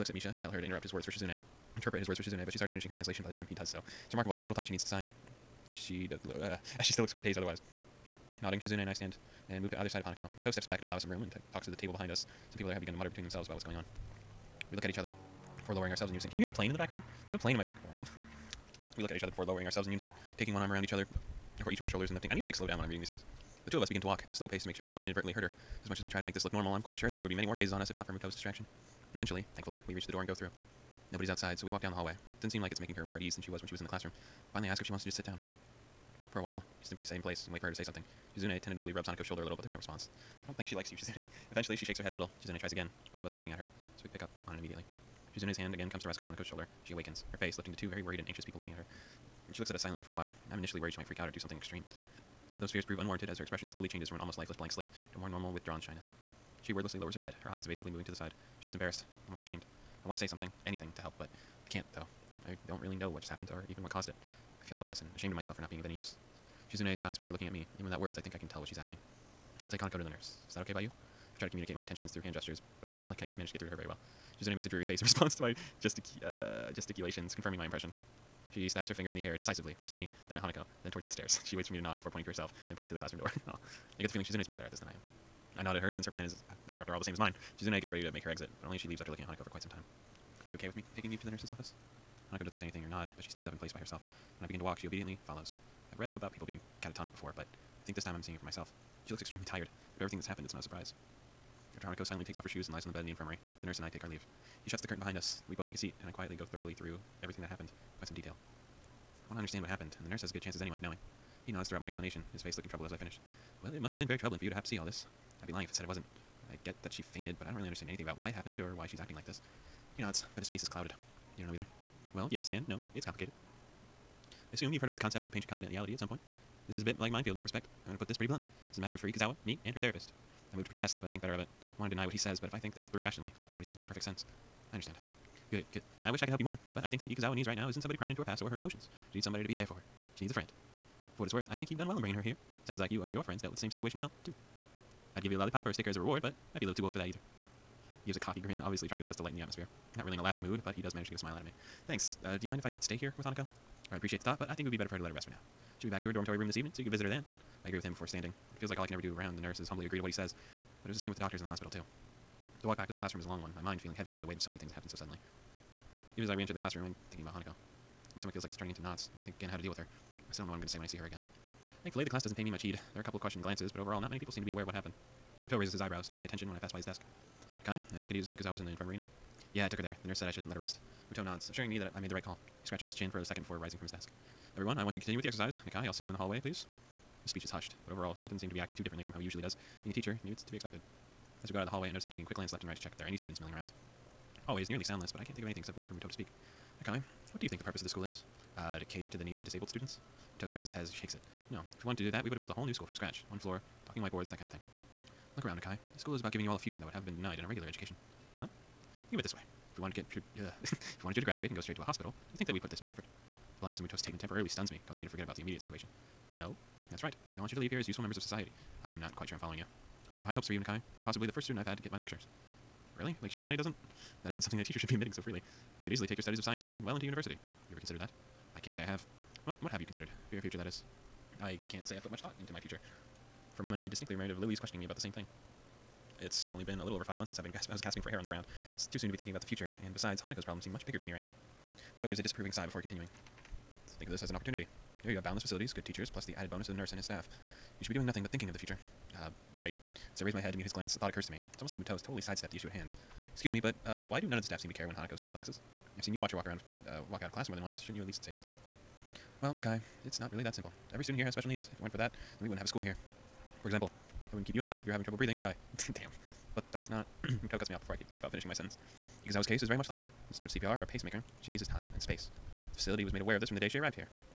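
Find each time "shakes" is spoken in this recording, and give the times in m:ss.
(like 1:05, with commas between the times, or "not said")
0:41, 3:20.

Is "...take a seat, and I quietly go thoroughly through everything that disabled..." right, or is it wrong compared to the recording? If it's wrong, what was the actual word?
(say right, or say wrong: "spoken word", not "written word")
wrong: "happened", not "disabled".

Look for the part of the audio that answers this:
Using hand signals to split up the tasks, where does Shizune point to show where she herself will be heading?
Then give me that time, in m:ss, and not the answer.
1:22.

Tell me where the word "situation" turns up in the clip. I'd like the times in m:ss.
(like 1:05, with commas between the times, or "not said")
2:23, 3:35.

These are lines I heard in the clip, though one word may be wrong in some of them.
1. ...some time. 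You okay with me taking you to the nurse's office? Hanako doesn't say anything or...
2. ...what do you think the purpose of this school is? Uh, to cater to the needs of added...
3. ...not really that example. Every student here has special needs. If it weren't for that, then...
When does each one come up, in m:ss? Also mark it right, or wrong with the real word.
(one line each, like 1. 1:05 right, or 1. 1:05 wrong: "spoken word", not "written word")
1. 1:29 right
2. 3:17 wrong: "disabled", not "added"
3. 4:20 wrong: "simple", not "example".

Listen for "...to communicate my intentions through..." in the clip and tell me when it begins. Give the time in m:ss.
1:11.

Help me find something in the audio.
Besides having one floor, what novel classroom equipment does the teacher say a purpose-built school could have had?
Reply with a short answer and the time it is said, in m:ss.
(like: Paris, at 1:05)
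talking whiteboards, at 3:23.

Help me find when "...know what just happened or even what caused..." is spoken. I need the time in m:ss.
1:02.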